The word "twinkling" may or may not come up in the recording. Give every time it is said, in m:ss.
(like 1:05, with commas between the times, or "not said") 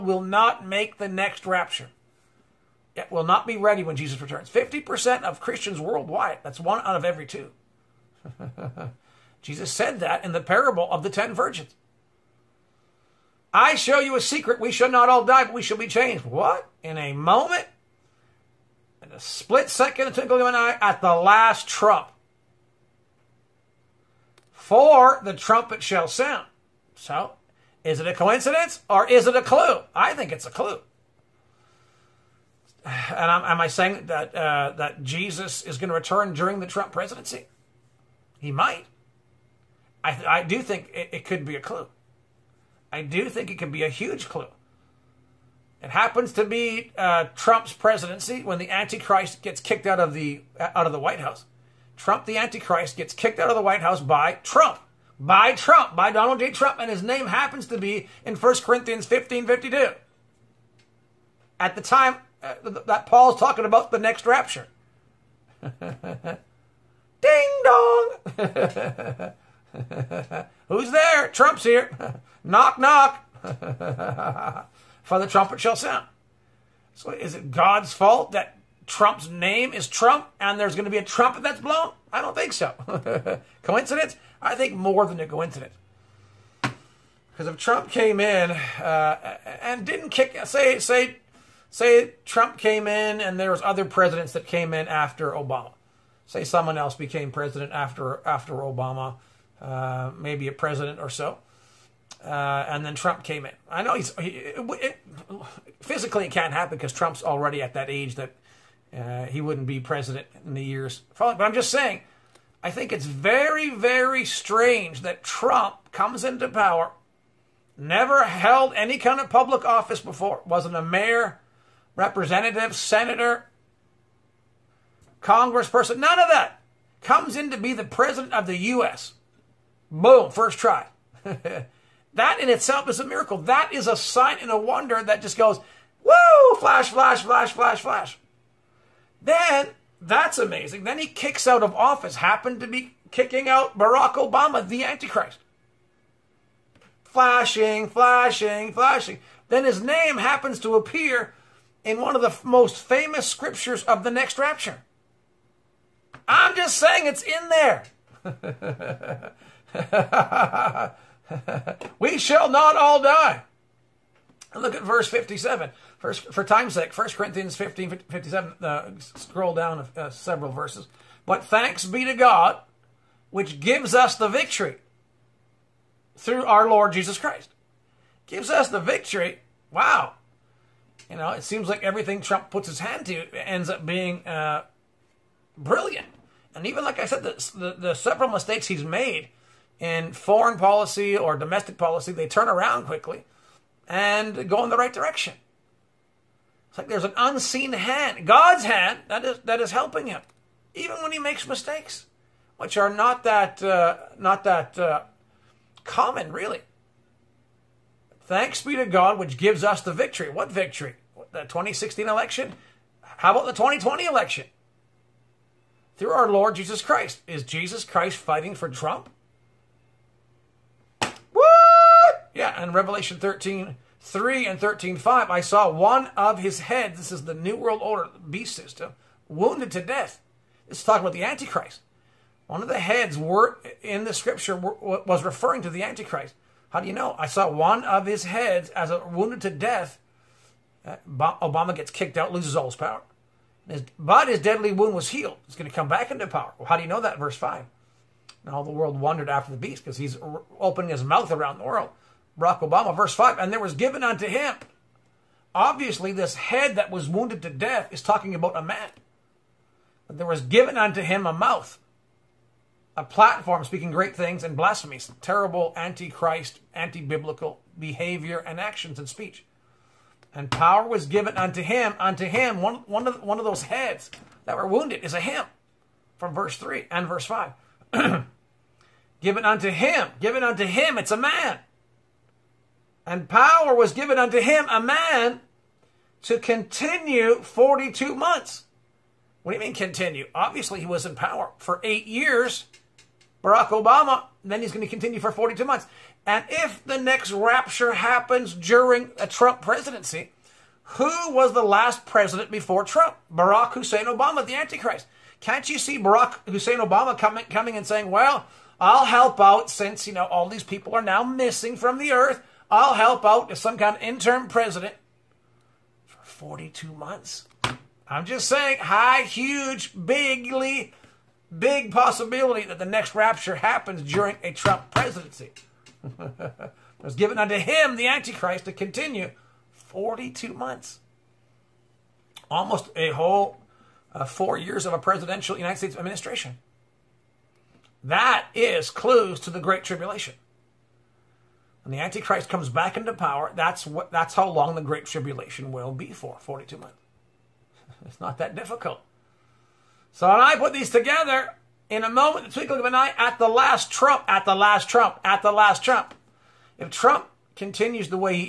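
0:20, 5:52.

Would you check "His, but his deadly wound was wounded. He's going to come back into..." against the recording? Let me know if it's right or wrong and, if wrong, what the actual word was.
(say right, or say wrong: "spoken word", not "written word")
wrong: "healed", not "wounded".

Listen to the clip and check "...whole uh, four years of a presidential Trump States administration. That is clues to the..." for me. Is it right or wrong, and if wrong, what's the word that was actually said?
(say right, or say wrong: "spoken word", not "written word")
wrong: "United", not "Trump".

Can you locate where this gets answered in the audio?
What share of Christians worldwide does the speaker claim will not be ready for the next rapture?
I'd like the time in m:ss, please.
0:04.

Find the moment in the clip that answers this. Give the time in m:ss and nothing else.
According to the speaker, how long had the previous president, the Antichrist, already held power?
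4:51.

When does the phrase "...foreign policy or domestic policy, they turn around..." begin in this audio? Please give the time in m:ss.
3:10.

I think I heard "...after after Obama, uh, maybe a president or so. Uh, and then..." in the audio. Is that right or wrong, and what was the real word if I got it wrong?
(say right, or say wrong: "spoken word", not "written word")
right.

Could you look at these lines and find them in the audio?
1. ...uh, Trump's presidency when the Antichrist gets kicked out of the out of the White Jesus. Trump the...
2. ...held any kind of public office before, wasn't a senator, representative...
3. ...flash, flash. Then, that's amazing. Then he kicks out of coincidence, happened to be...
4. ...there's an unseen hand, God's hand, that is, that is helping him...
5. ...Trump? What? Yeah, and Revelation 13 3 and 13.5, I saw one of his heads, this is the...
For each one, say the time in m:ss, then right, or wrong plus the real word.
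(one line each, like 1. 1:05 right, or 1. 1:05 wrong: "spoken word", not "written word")
1. 0:46 wrong: "House", not "Jesus"
2. 1:58 wrong: "mayor", not "senator"
3. 2:17 wrong: "office", not "coincidence"
4. 3:16 right
5. 3:38 right.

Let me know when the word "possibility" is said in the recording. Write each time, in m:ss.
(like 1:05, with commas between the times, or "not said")
5:21.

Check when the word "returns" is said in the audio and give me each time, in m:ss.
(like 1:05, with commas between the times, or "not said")
0:04, 0:36.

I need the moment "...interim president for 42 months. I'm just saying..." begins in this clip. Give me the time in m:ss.
5:14.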